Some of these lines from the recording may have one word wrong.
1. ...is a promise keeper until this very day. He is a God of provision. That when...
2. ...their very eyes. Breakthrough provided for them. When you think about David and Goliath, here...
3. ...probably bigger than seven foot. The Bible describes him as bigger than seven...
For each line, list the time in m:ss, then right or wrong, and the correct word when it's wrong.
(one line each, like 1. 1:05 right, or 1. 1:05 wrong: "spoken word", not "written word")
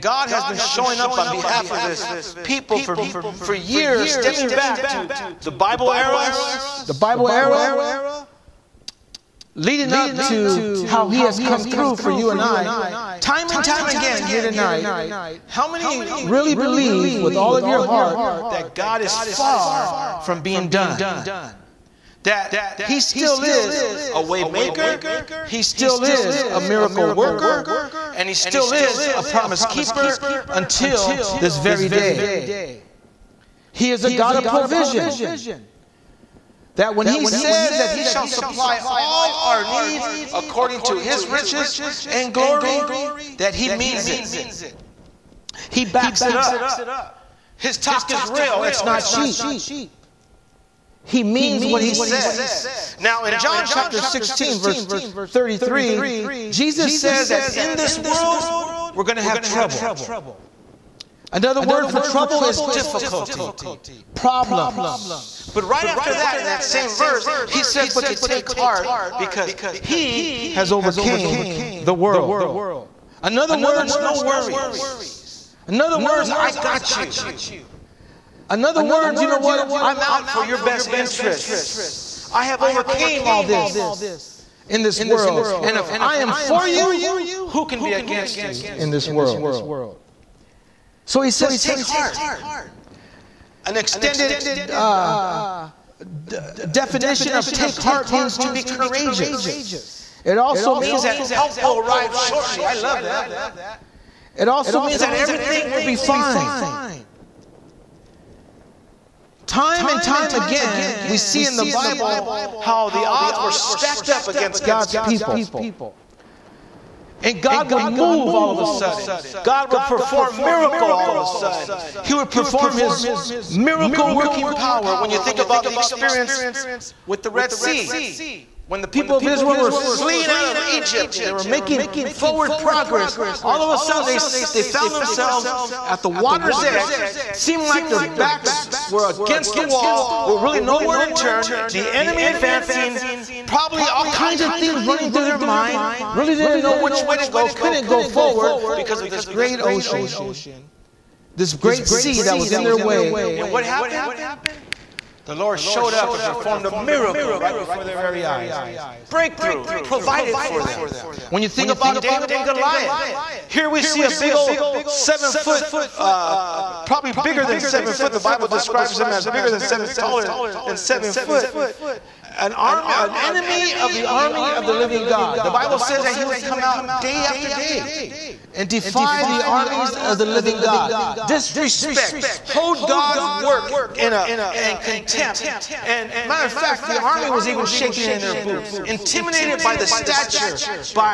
1. 0:28 right
2. 2:37 right
3. 2:46 right.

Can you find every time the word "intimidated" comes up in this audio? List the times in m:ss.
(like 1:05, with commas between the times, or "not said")
3:08.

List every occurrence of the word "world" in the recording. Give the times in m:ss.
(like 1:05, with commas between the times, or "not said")
0:57, 1:11, 1:25, 1:29.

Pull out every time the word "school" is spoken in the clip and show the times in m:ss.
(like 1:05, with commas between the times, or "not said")
not said.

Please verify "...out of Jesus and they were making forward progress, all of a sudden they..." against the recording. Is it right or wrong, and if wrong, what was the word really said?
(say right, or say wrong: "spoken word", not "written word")
wrong: "Egypt", not "Jesus".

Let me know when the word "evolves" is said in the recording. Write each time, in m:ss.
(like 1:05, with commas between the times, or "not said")
not said.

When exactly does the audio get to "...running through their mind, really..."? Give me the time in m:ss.
2:24.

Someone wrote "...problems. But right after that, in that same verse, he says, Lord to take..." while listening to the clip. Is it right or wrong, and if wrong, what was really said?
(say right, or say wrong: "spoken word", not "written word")
wrong: "But", not "Lord".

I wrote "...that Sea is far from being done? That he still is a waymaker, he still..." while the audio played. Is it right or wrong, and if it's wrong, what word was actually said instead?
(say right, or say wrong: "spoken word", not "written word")
wrong: "God", not "Sea".